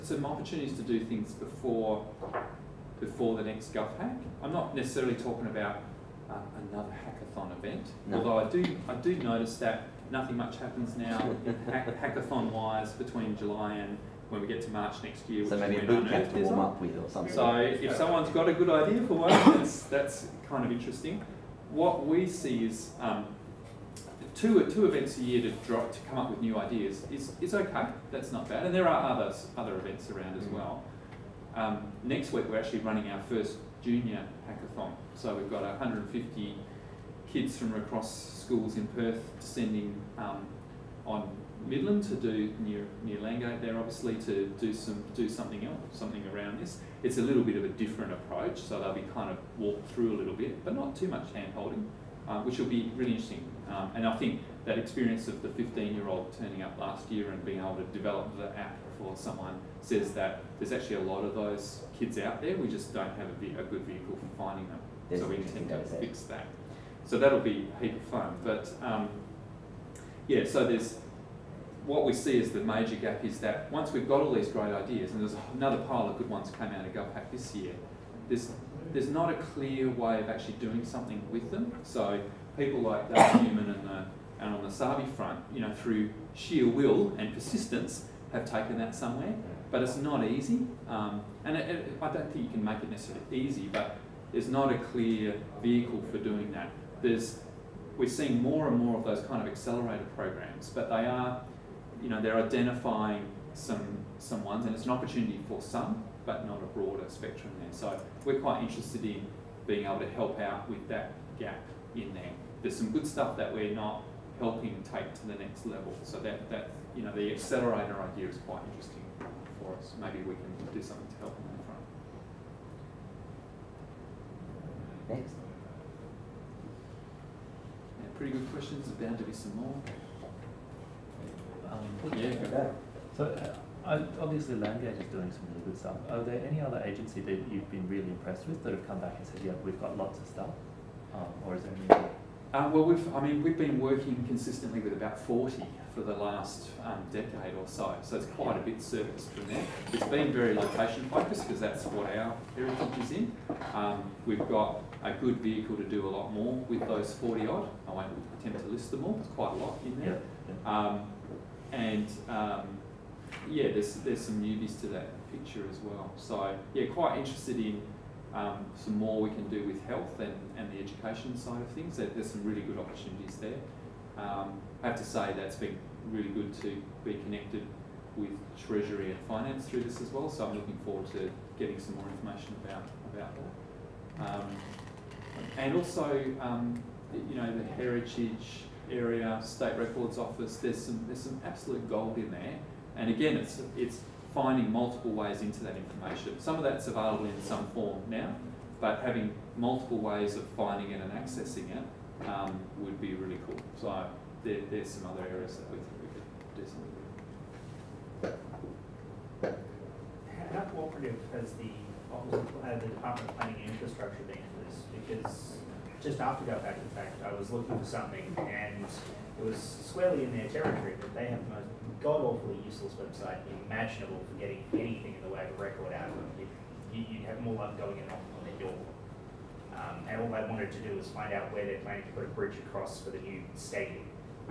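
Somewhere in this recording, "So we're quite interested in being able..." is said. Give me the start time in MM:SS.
01:47.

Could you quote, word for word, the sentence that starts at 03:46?
You'd, you'd have more luck going in off on their door.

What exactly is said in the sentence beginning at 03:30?
How cooperative has the, uh, the Department of Planning and Infrastructure been in this?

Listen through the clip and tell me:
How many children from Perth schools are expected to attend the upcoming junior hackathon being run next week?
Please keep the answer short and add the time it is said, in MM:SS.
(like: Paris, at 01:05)
150, at 00:35.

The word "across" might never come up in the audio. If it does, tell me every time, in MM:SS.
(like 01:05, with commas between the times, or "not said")
00:37, 03:52.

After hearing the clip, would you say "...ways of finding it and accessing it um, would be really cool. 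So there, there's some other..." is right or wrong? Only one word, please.
right.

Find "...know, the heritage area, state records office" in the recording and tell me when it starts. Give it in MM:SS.
03:07.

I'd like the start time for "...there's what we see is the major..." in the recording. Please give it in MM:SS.
01:10.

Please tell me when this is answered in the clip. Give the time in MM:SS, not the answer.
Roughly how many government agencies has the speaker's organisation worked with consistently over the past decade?
02:24.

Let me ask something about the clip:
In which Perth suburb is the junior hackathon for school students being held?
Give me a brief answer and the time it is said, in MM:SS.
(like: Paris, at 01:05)
Midland, at 00:41.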